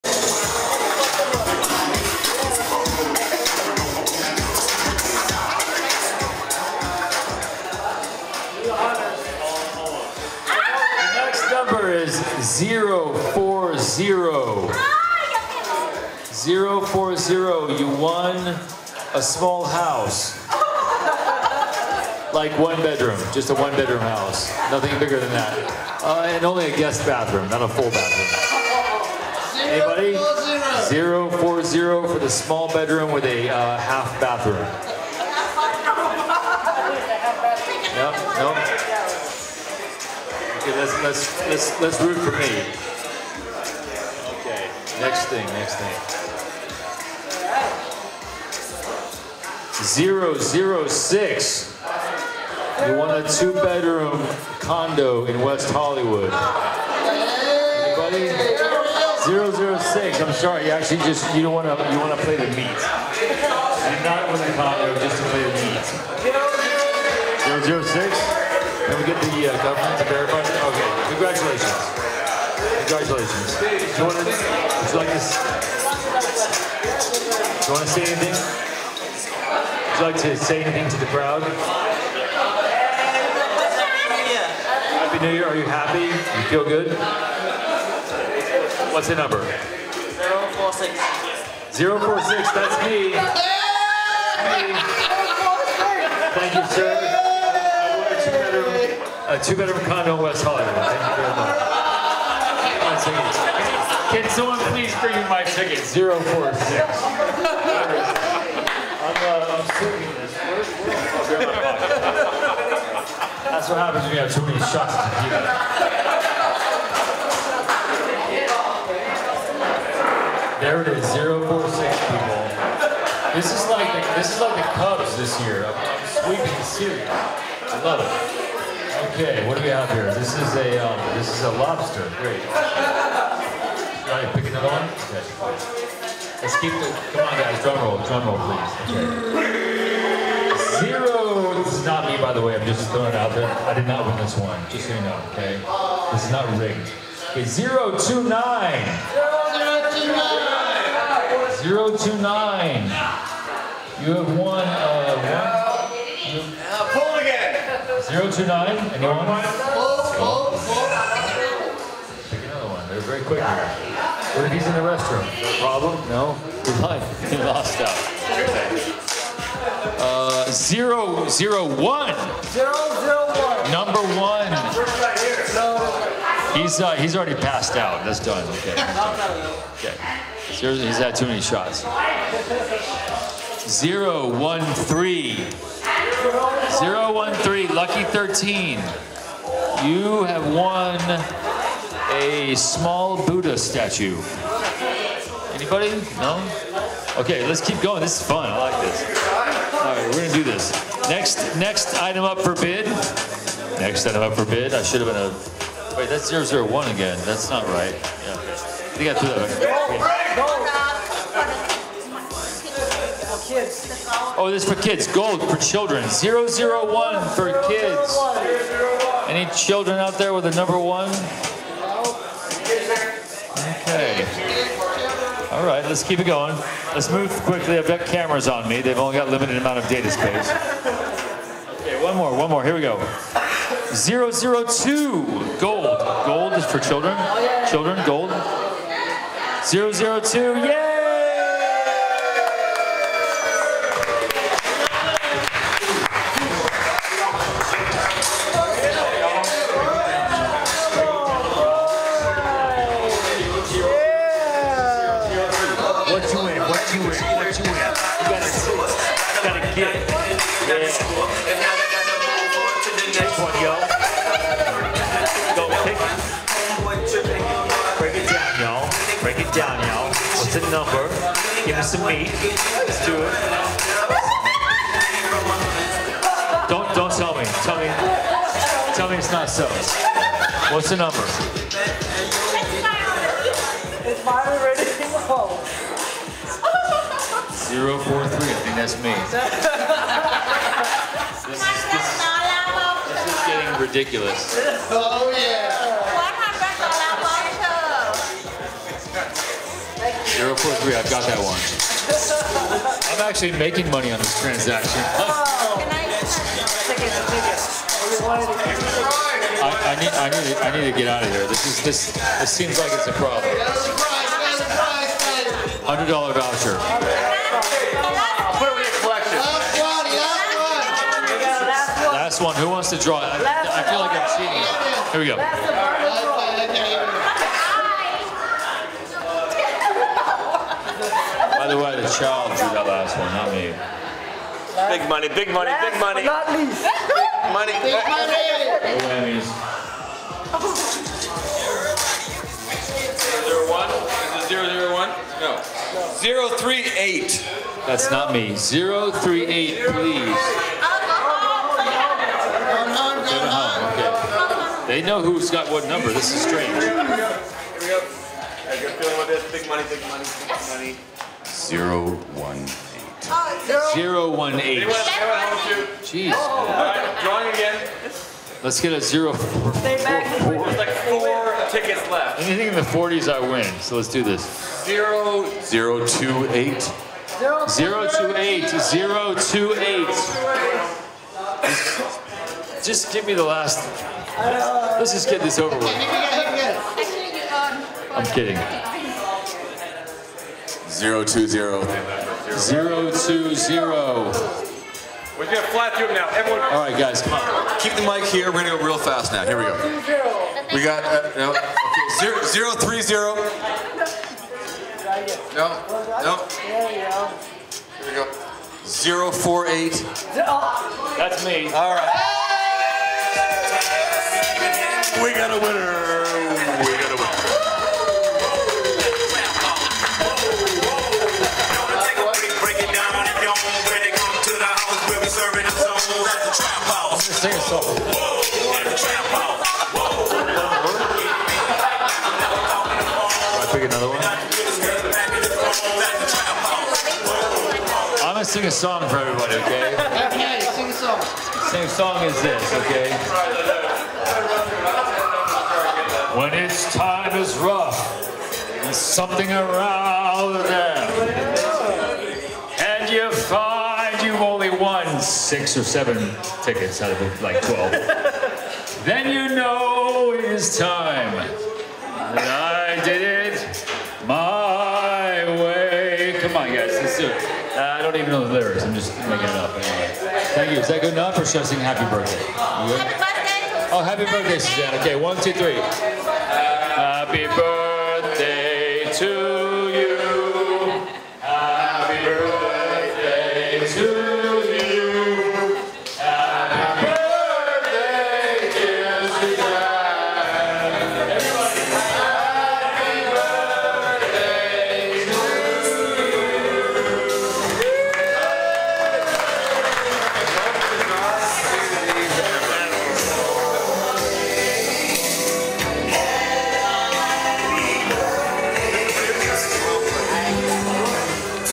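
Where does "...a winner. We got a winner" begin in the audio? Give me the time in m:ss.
6:55.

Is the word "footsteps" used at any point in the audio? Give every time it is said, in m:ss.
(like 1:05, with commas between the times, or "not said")
not said.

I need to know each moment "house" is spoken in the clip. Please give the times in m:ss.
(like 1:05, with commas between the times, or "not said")
0:19, 0:23.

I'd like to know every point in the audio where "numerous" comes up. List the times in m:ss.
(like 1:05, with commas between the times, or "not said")
not said.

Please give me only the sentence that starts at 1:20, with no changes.
like to say anything to the crowd?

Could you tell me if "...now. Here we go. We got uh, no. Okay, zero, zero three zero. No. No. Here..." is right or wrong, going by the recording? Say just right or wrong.
right.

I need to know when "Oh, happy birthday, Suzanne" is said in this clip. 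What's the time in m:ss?
7:53.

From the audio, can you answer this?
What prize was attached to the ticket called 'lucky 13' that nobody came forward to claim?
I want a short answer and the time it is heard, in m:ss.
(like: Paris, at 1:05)
small Buddha statue, at 3:12.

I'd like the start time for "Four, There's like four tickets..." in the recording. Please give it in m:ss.
6:10.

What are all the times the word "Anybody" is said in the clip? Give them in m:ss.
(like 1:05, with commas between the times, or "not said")
0:29, 0:56, 3:15.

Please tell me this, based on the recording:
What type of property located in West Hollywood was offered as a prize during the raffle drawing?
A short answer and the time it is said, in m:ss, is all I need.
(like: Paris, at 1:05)
two-bedroom condo, at 1:39.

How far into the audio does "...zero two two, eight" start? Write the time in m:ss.
6:15.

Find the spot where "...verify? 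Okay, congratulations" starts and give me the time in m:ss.
1:10.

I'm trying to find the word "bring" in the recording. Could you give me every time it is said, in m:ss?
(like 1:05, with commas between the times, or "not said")
1:44.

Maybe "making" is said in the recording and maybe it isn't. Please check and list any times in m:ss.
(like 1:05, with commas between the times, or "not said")
5:03, 7:49.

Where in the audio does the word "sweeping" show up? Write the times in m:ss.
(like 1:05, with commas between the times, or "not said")
2:06.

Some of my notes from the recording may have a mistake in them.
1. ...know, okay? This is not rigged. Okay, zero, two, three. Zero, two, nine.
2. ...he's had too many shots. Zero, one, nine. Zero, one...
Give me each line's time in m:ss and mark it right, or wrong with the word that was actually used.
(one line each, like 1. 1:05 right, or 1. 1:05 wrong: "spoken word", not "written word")
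1. 2:25 wrong: "nine", not "three"
2. 3:00 wrong: "three", not "nine".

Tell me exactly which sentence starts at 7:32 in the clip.
And you find you've only won six or seven tickets out of like 12.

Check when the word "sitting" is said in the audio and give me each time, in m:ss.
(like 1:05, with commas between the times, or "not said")
1:49.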